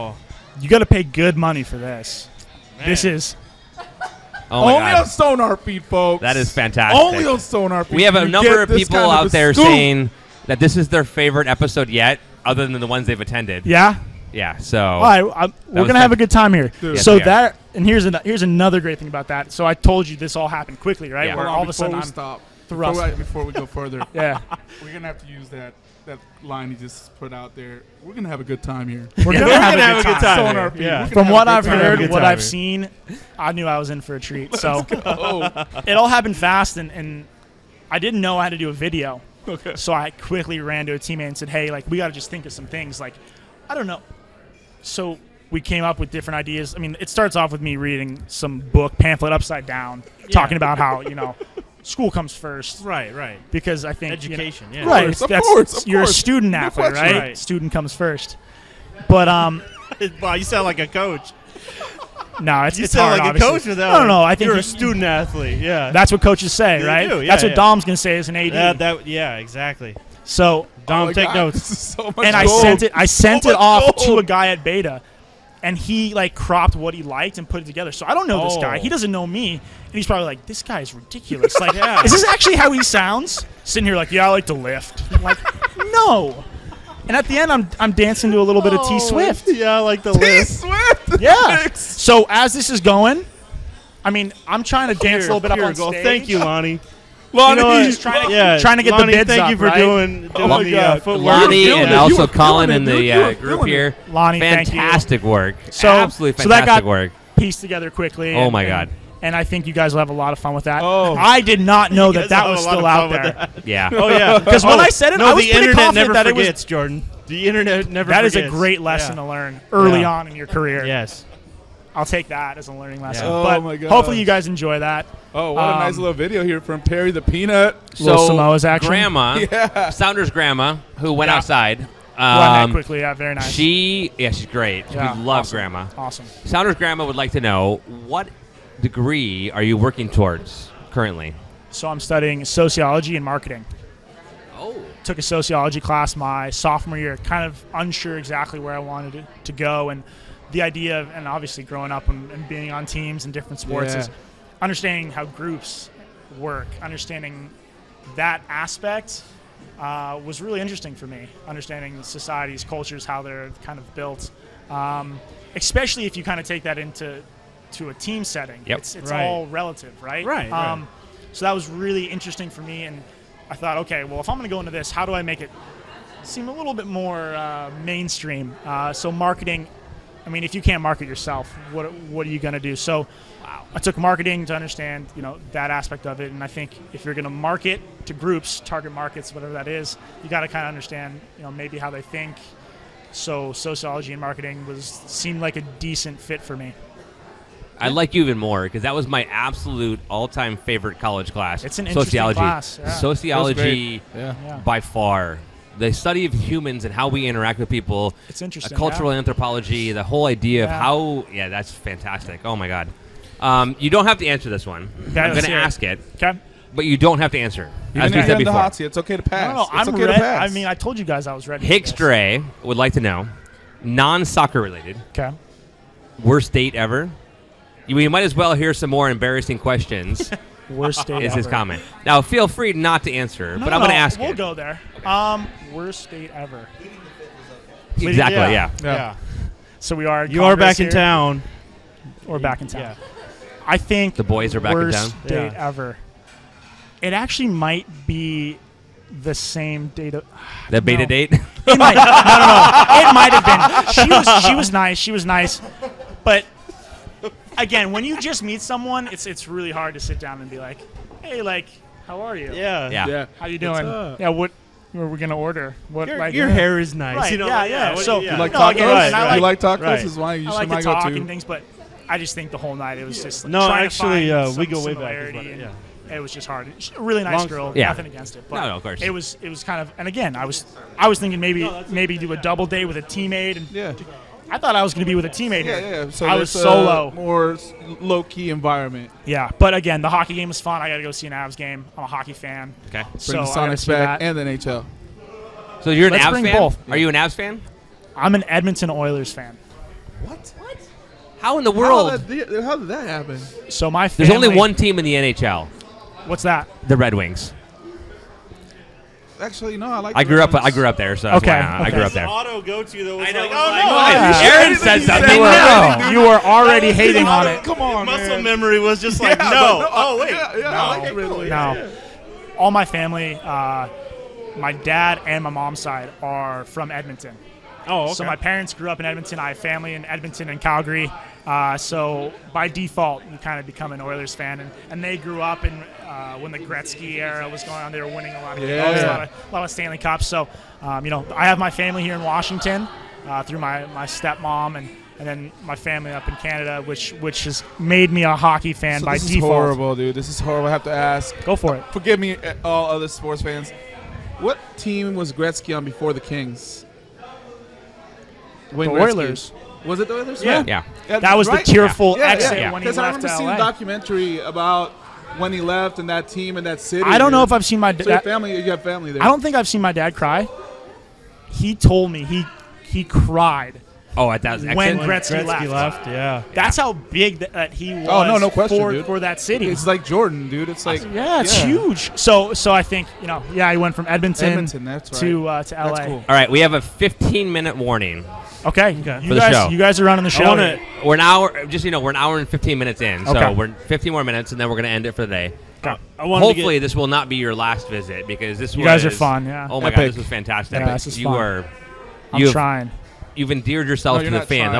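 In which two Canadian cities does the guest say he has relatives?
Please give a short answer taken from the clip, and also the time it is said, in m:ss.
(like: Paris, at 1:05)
Edmonton and Calgary, at 5:30.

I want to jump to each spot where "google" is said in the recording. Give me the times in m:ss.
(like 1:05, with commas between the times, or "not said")
not said.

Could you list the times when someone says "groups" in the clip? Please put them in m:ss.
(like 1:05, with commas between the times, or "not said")
1:43, 2:35, 3:08.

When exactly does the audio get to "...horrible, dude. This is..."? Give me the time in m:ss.
5:49.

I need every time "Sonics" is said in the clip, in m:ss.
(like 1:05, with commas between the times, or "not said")
4:53.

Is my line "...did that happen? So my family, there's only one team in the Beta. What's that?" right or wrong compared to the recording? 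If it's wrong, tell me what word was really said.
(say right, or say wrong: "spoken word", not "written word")
wrong: "NHL", not "Beta".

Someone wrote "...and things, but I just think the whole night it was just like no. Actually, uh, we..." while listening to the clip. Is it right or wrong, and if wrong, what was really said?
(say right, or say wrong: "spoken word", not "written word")
right.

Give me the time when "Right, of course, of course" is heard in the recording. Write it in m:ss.
0:54.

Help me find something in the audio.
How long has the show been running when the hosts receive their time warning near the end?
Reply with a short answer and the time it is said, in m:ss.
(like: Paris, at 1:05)
1 hour 15 minutes, at 6:32.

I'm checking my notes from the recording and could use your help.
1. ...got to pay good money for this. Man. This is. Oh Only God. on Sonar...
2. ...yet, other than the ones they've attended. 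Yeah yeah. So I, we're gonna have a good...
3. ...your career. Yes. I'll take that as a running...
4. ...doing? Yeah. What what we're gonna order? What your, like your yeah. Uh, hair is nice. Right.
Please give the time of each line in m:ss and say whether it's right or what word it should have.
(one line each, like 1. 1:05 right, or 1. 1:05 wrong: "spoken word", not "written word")
1. 0:00 right
2. 0:11 right
3. 2:00 wrong: "learning", not "running"
4. 4:23 right.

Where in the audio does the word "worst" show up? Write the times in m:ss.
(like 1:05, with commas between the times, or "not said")
3:46, 3:50, 3:55.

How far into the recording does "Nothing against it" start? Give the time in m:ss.
4:37.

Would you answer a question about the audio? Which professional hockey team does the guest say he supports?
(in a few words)
Edmonton Oilers.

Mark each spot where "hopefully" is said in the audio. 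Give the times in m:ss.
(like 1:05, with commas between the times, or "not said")
2:03, 6:36.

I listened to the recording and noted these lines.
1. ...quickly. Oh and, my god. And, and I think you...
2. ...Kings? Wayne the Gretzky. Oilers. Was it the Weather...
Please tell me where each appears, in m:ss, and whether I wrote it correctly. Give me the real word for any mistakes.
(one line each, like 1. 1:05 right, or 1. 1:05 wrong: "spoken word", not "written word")
1. 1:47 right
2. 5:56 right.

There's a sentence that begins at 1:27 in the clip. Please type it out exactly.
And at the end, I'm I'm dancing to a little oh, bit of T oh.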